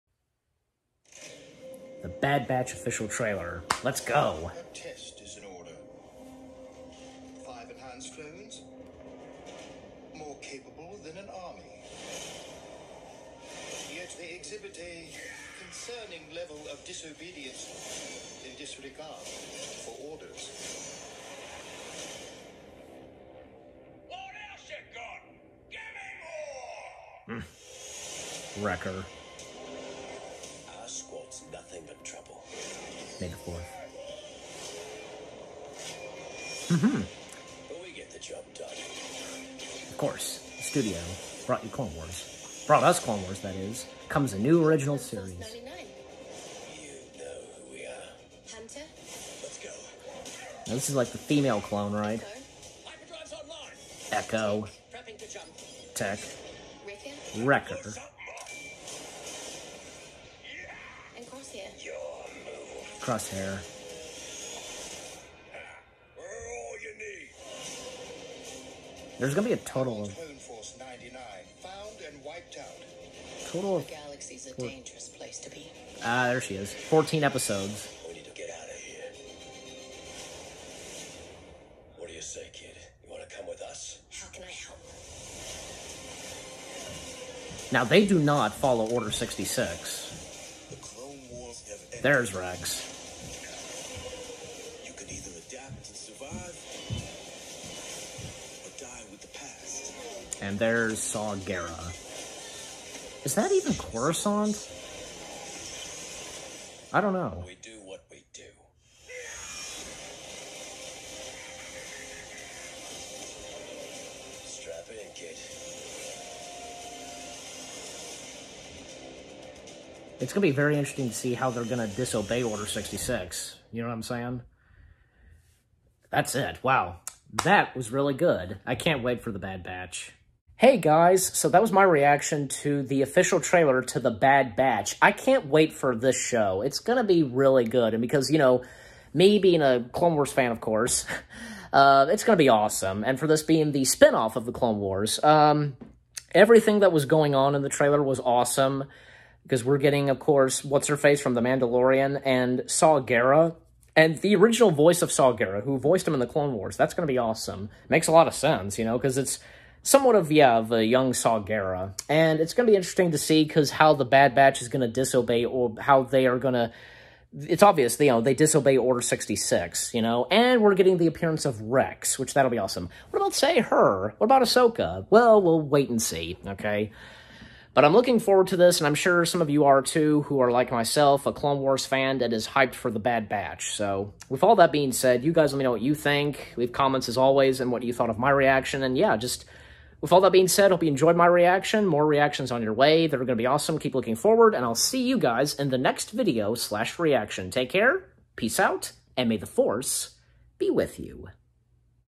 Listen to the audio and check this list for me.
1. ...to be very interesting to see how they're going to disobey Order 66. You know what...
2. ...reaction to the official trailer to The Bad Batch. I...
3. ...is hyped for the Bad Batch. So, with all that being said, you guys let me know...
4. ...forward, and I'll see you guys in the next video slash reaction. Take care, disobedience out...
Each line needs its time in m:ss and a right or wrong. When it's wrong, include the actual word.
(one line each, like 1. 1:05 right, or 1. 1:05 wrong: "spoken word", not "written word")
1. 2:00 right
2. 2:11 right
3. 3:02 right
4. 3:14 wrong: "peace", not "disobedience".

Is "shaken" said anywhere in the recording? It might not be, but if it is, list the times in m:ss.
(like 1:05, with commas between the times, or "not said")
not said.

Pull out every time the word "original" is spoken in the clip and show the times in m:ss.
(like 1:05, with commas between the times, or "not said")
0:44, 2:34.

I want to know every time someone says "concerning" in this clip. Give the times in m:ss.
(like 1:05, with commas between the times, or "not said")
0:15.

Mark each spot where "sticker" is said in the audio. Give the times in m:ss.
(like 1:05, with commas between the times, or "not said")
not said.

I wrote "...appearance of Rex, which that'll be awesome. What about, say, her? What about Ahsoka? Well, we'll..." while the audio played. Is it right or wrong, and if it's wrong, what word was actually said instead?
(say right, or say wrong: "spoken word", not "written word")
right.